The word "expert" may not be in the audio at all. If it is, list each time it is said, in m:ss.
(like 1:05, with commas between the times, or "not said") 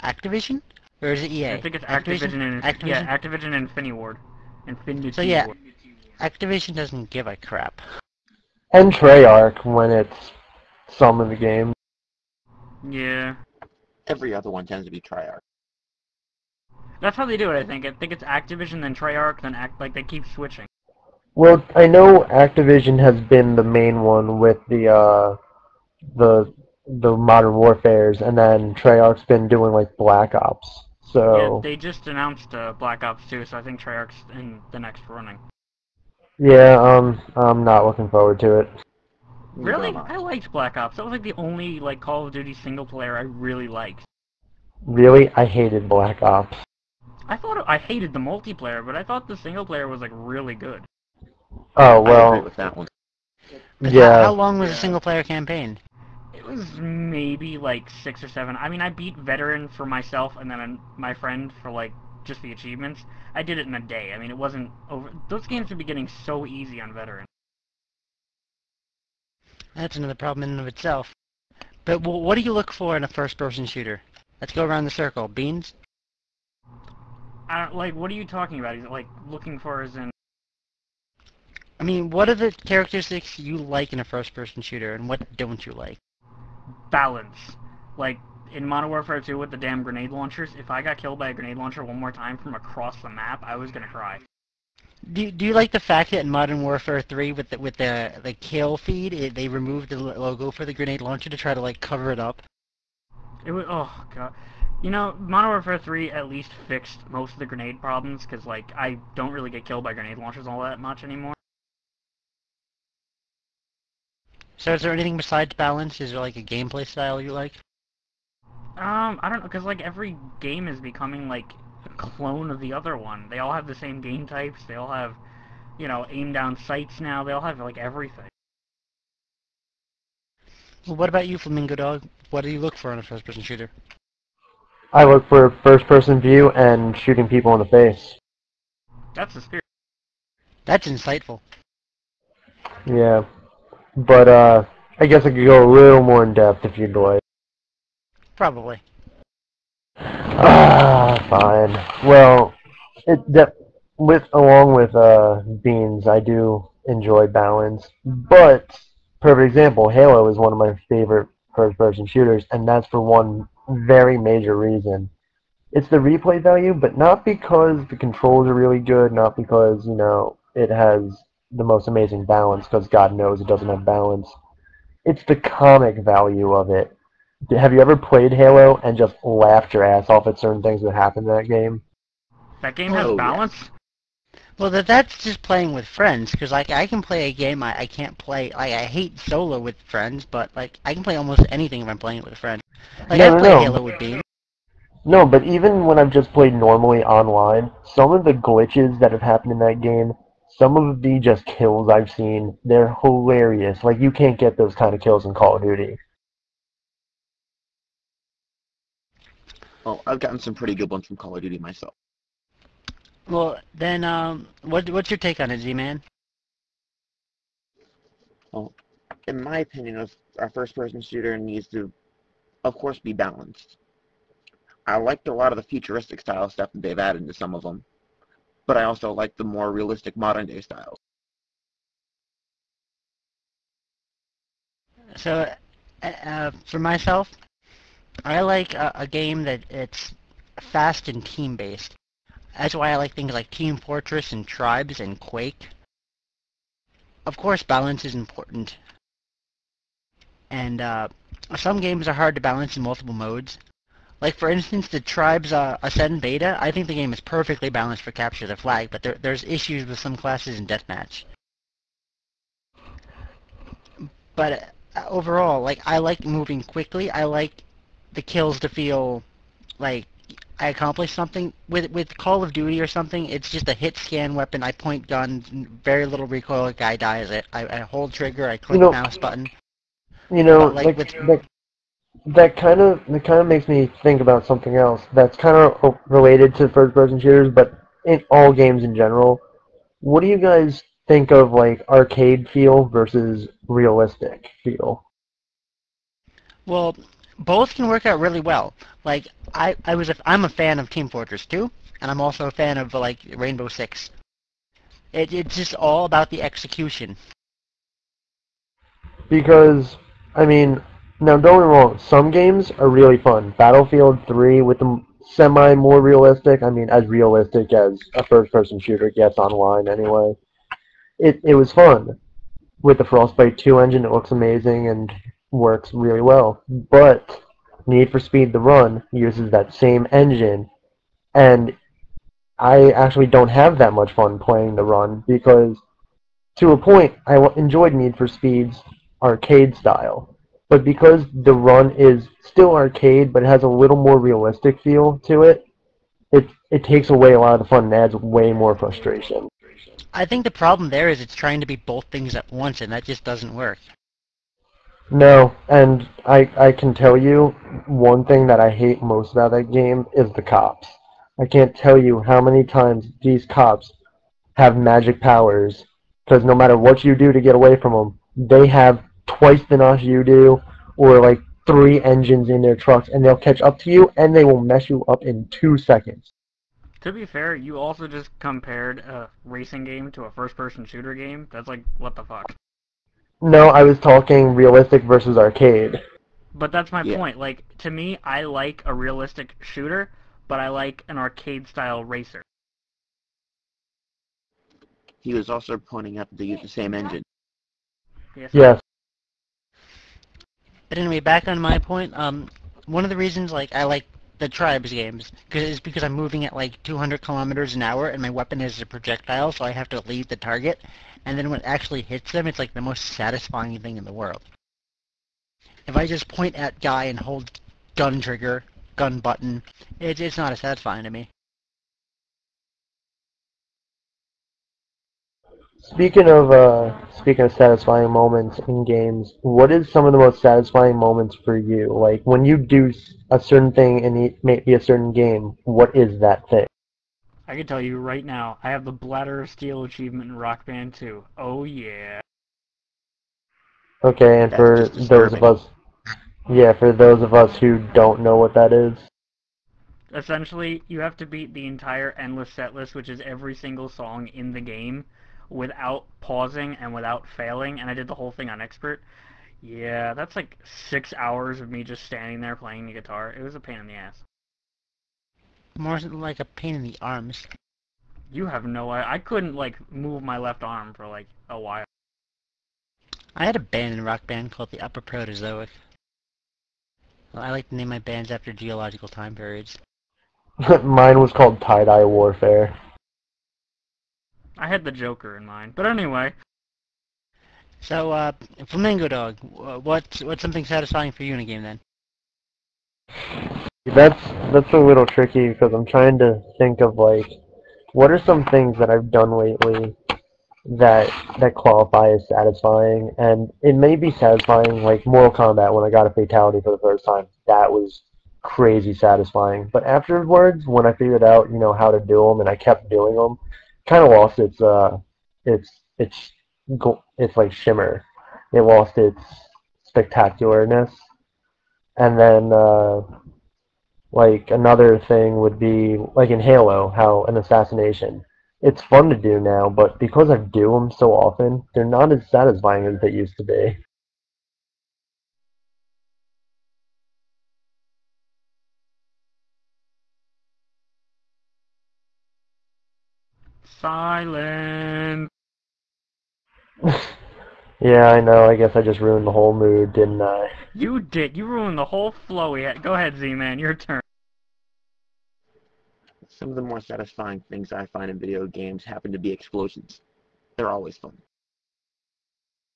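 7:38.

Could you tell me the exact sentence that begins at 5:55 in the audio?
No, and I I can tell you one thing that I hate most about that game is the cops.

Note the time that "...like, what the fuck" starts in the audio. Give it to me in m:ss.
6:21.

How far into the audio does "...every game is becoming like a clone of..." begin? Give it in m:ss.
1:59.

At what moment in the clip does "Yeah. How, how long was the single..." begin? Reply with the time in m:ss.
0:53.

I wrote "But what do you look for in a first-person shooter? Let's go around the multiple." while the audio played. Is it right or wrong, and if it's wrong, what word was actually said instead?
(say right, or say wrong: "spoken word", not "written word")
wrong: "circle", not "multiple".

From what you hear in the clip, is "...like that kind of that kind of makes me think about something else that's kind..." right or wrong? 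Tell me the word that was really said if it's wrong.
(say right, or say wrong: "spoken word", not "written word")
right.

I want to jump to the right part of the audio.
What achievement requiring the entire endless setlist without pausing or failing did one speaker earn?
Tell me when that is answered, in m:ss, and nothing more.
7:18.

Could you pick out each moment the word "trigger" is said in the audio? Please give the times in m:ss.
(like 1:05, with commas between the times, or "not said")
4:38, 6:58.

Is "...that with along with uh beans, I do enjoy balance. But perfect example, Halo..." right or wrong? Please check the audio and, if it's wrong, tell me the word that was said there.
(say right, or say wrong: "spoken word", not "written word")
right.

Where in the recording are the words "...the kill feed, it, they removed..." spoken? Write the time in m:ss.
1:38.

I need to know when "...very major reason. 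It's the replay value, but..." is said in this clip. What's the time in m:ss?
2:43.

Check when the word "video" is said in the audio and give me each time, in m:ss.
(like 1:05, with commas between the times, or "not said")
9:18.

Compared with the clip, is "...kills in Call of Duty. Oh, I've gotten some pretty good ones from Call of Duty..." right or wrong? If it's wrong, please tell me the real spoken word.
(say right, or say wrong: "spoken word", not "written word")
right.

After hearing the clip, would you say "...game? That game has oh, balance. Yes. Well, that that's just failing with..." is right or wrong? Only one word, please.
wrong.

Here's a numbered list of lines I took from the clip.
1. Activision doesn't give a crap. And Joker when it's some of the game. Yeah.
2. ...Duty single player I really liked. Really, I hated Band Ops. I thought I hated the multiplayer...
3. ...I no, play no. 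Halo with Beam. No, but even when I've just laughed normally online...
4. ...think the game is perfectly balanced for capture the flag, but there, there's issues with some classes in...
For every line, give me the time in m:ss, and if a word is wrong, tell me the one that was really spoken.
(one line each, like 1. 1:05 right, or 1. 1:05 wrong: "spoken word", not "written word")
1. 0:06 wrong: "Treyarch", not "Joker"
2. 0:42 wrong: "Black", not "Band"
3. 3:13 wrong: "played", not "laughed"
4. 4:16 right.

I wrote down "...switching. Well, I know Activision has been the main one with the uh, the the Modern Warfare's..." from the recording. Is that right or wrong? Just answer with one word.
right.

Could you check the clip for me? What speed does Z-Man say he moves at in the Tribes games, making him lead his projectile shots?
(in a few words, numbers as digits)
200 kilometers an hour.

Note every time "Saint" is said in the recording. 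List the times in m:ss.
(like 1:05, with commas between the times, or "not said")
not said.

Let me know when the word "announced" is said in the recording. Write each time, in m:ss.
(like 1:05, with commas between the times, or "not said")
0:32.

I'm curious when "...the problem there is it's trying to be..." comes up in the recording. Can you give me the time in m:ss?
5:50.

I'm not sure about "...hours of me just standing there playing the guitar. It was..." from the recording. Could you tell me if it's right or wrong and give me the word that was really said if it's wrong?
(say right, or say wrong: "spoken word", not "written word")
right.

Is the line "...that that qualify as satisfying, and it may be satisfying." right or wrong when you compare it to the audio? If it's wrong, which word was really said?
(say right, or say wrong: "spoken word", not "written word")
right.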